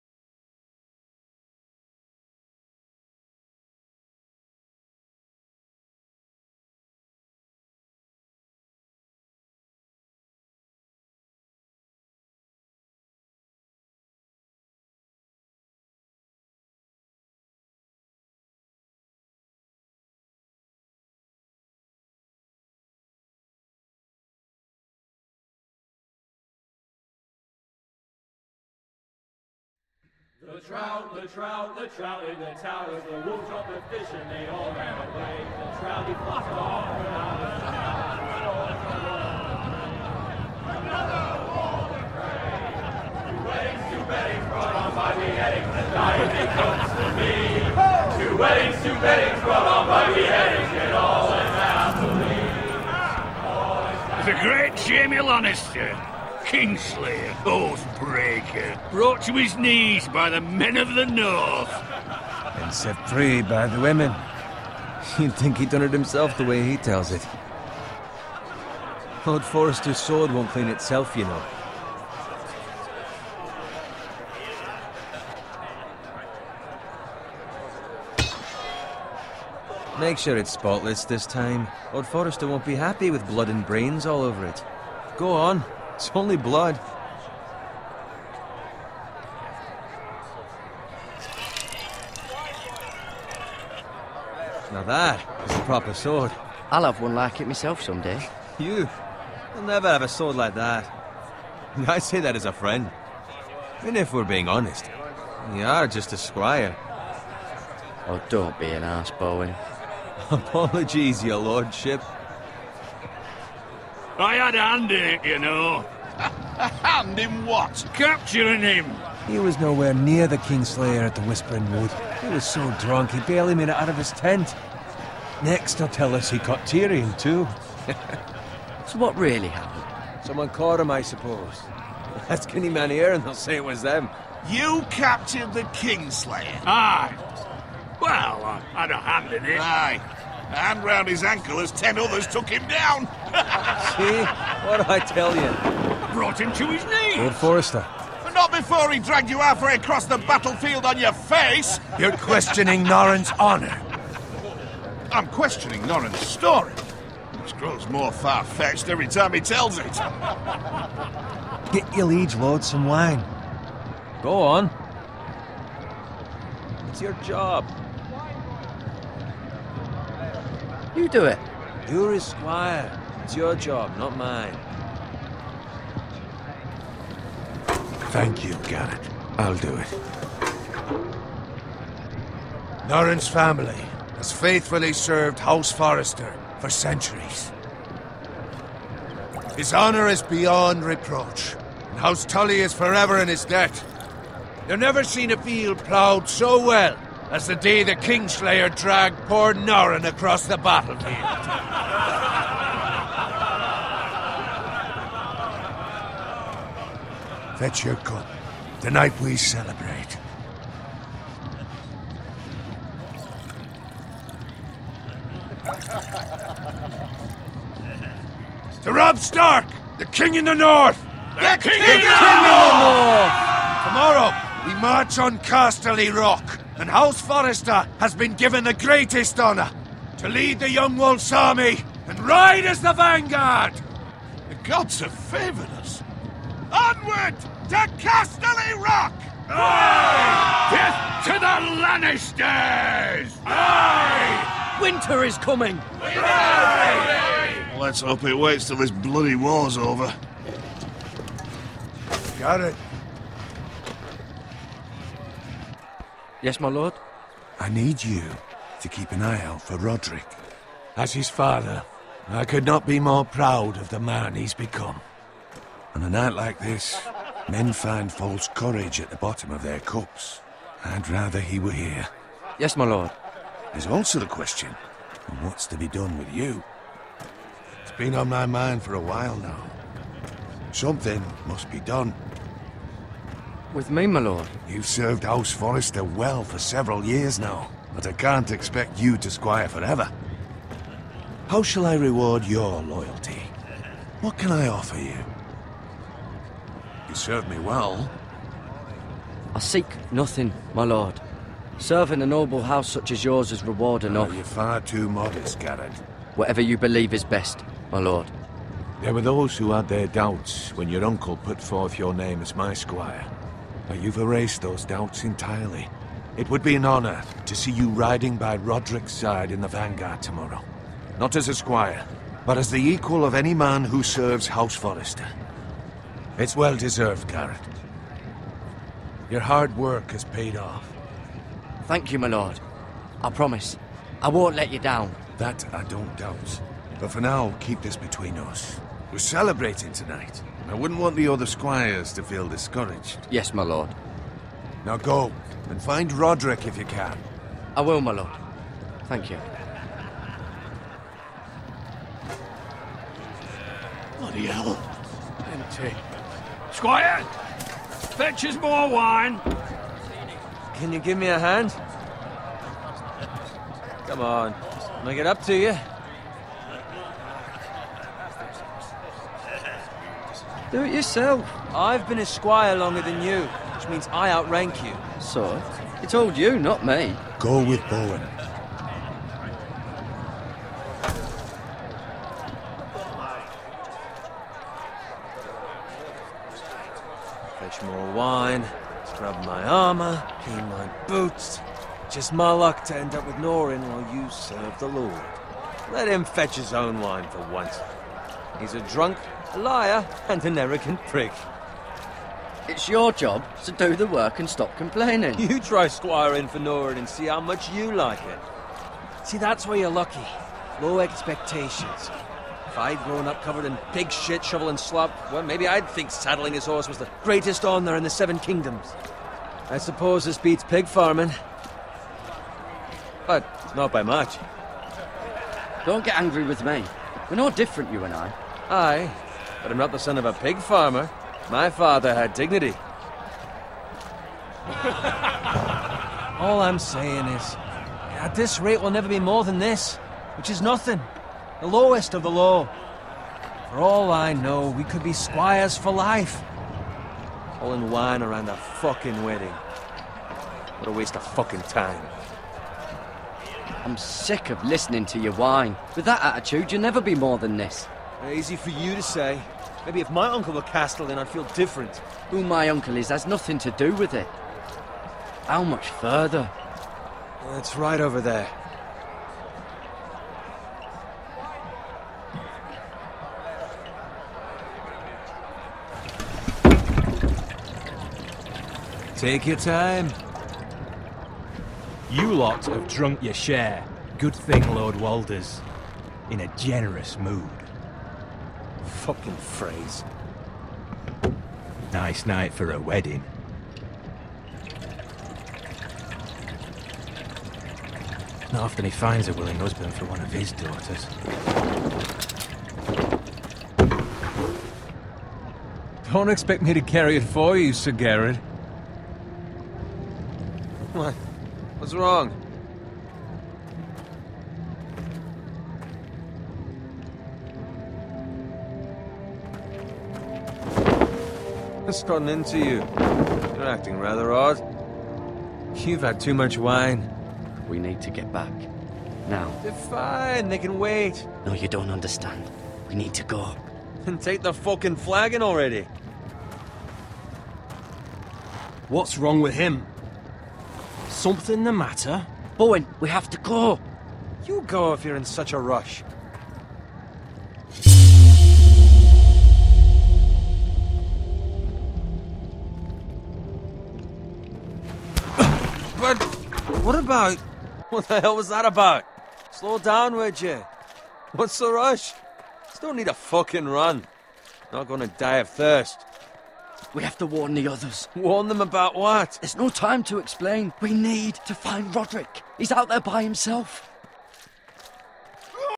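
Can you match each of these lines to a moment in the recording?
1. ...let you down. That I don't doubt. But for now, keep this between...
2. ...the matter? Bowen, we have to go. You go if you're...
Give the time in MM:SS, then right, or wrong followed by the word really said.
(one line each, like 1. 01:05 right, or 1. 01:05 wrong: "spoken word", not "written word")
1. 05:34 right
2. 09:01 right.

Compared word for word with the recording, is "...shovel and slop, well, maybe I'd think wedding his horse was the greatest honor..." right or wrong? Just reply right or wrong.
wrong.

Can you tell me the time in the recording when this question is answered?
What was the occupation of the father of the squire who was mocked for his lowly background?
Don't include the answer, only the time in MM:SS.
07:10.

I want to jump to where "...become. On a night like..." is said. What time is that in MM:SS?
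04:24.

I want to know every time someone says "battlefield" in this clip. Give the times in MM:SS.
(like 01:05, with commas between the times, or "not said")
02:30, 03:20.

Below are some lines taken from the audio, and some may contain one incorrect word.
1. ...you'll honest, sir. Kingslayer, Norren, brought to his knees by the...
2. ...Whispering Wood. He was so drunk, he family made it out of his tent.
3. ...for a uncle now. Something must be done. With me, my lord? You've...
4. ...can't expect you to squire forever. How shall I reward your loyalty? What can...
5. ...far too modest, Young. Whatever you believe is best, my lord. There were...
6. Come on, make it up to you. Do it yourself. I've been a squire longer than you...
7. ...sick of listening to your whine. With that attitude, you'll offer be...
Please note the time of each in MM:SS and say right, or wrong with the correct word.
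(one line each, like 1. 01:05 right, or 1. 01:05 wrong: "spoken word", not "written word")
1. 00:55 wrong: "Oathbreaker", not "Norren"
2. 02:01 wrong: "barely", not "family"
3. 04:38 wrong: "while", not "uncle"
4. 04:48 right
5. 05:04 wrong: "Gared", not "Young"
6. 06:04 right
7. 07:33 wrong: "never", not "offer".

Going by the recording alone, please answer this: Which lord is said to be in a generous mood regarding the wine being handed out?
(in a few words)
Lord Walder.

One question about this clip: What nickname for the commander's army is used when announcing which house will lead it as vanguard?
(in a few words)
Young Wolf.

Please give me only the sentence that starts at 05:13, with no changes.
But you've erased those doubts entirely.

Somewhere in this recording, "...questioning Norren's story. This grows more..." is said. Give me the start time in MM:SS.
02:35.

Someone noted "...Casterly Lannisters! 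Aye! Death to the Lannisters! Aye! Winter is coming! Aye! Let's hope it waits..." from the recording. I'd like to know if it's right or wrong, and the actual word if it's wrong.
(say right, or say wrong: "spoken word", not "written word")
wrong: "Rock", not "Lannisters".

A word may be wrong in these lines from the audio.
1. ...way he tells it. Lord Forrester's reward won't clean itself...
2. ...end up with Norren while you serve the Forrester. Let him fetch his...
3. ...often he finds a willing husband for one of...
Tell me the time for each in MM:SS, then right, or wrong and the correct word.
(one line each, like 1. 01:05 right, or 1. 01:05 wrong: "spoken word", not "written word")
1. 01:06 wrong: "sword", not "reward"
2. 06:32 wrong: "Lord", not "Forrester"
3. 08:18 right.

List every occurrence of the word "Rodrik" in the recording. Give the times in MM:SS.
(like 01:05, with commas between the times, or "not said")
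04:19, 05:18, 05:46, 09:31.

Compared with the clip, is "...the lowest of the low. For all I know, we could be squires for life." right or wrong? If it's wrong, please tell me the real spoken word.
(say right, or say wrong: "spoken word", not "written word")
right.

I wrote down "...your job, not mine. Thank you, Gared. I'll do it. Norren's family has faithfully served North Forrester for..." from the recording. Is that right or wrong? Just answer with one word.
wrong.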